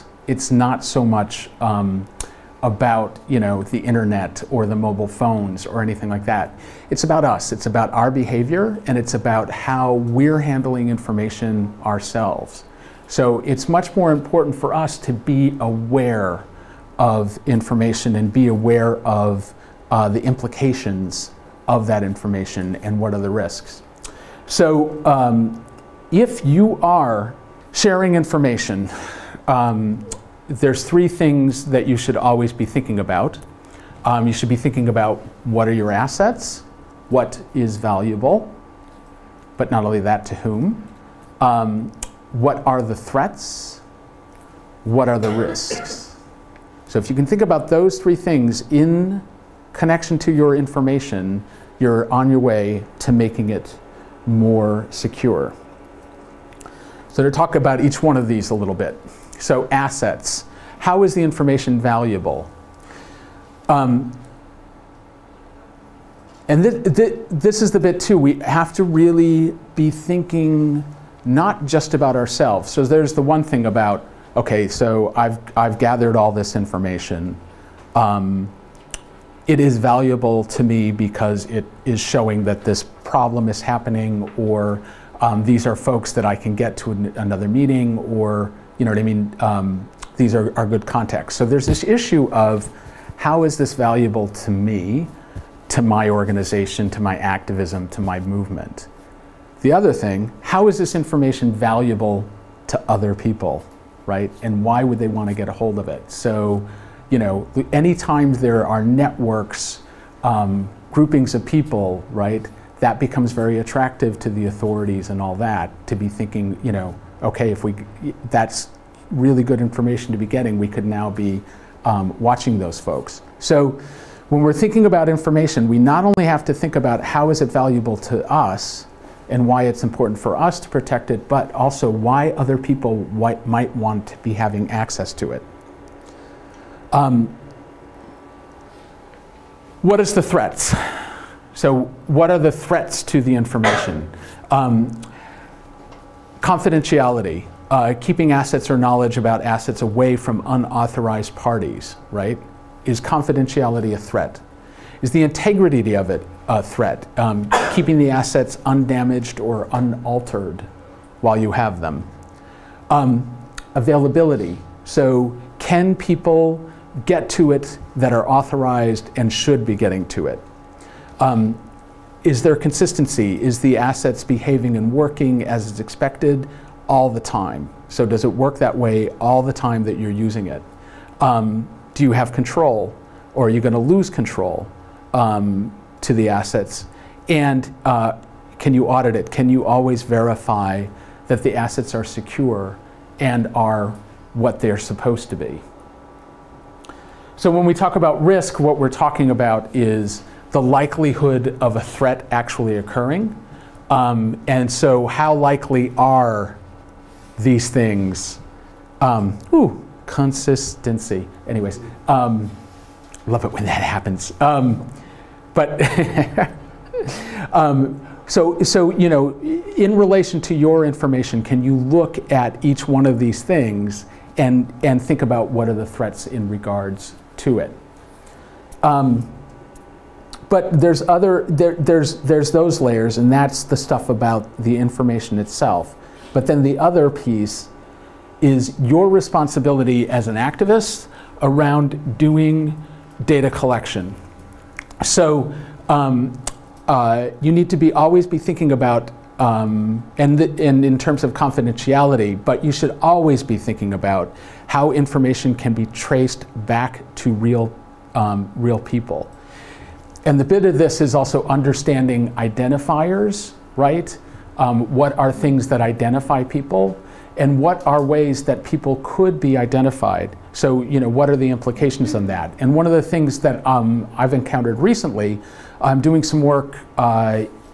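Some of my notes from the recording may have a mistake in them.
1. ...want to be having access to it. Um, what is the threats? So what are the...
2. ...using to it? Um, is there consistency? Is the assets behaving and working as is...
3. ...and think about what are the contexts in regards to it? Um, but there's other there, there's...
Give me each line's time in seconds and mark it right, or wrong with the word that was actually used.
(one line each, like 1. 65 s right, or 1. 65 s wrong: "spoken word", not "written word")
1. 133 s right
2. 169 s wrong: "getting", not "using"
3. 224 s wrong: "threats", not "contexts".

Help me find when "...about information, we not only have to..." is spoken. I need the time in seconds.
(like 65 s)
124 s.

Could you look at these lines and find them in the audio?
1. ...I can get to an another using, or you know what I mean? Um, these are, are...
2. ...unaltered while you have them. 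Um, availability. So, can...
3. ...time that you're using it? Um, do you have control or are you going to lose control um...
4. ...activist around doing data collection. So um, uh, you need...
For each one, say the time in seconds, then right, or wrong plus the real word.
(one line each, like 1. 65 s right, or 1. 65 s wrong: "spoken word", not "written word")
1. 86 s wrong: "meeting", not "using"
2. 159 s right
3. 179 s right
4. 240 s right.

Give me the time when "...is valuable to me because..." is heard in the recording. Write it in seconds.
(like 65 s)
79 s.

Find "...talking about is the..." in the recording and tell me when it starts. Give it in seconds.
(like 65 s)
198 s.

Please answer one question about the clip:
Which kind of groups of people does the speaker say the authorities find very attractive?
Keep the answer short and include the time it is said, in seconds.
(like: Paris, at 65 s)
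networks, at 108 s.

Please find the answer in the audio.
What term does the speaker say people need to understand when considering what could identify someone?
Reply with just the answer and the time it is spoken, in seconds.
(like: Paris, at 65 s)
identifiers, at 262 s.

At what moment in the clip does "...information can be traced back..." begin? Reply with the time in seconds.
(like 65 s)
254 s.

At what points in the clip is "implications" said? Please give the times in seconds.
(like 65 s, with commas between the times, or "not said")
20 s, 271 s.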